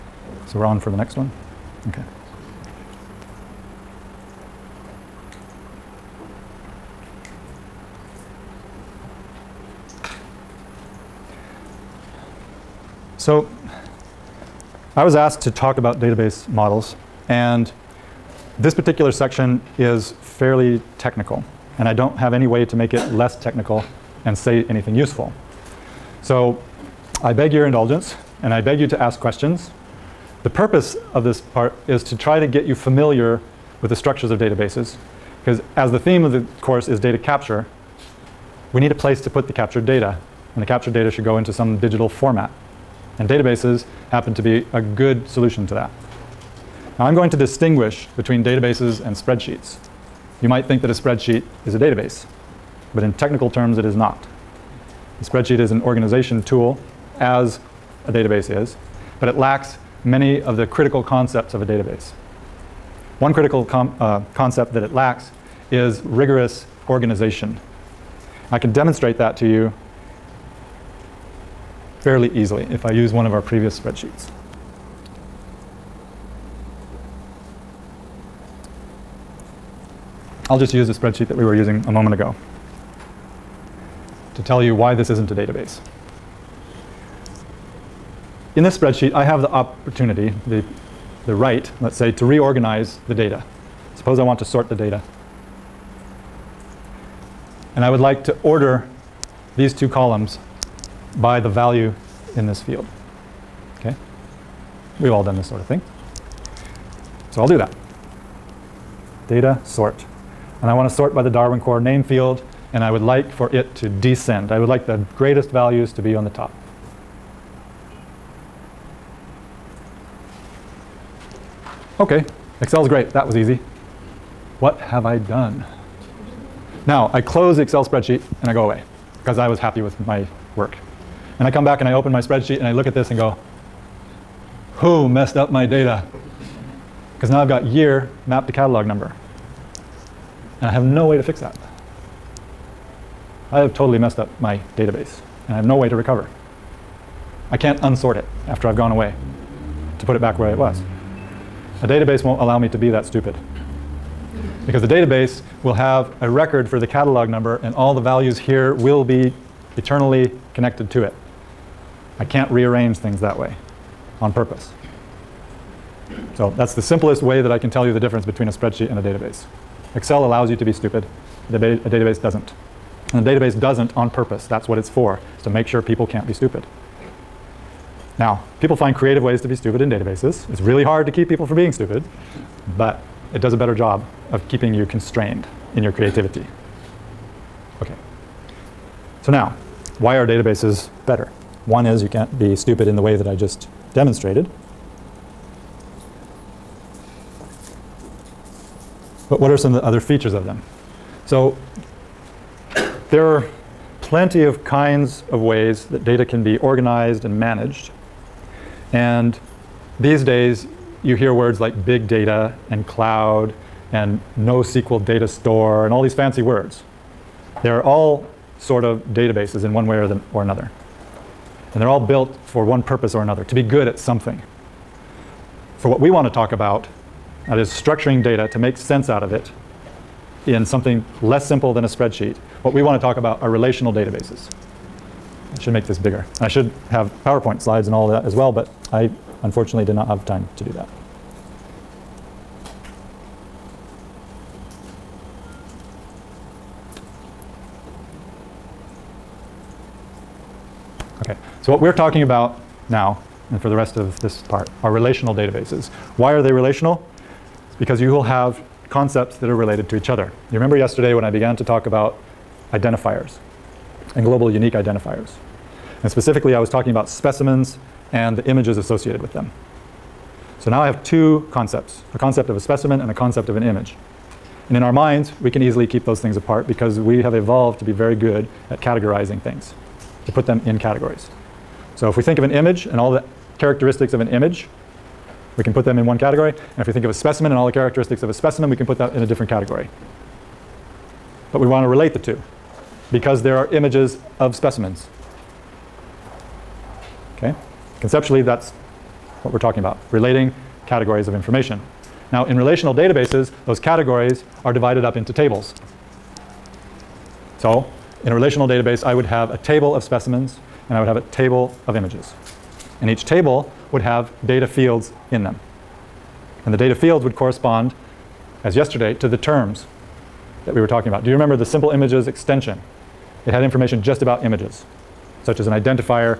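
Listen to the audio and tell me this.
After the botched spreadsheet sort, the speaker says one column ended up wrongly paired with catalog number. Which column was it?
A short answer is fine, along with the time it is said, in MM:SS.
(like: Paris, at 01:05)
year, at 02:17.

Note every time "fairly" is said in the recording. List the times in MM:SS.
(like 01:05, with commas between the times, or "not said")
00:20, 01:11.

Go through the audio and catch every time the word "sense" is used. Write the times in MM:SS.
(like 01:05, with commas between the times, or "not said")
03:48.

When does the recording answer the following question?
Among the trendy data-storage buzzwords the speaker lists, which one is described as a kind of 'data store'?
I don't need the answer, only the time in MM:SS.
03:34.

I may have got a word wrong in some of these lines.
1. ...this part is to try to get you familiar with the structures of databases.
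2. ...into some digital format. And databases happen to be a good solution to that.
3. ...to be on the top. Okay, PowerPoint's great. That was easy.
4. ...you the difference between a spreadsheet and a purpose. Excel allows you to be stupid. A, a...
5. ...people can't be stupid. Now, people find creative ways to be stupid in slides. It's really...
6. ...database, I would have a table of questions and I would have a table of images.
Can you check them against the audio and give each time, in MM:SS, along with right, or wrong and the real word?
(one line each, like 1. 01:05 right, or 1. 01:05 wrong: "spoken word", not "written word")
1. 00:31 right
2. 00:41 right
3. 01:55 wrong: "Excel", not "PowerPoint"
4. 02:47 wrong: "database", not "purpose"
5. 02:55 wrong: "databases", not "slides"
6. 05:08 wrong: "specimens", not "questions".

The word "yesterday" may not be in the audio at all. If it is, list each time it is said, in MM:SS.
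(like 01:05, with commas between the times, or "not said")
04:20, 05:18.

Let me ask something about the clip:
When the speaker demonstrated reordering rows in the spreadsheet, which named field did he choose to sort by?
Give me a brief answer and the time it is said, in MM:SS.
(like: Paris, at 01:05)
Darwin core name, at 01:51.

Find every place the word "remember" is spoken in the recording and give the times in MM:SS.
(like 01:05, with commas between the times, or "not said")
04:20, 05:21.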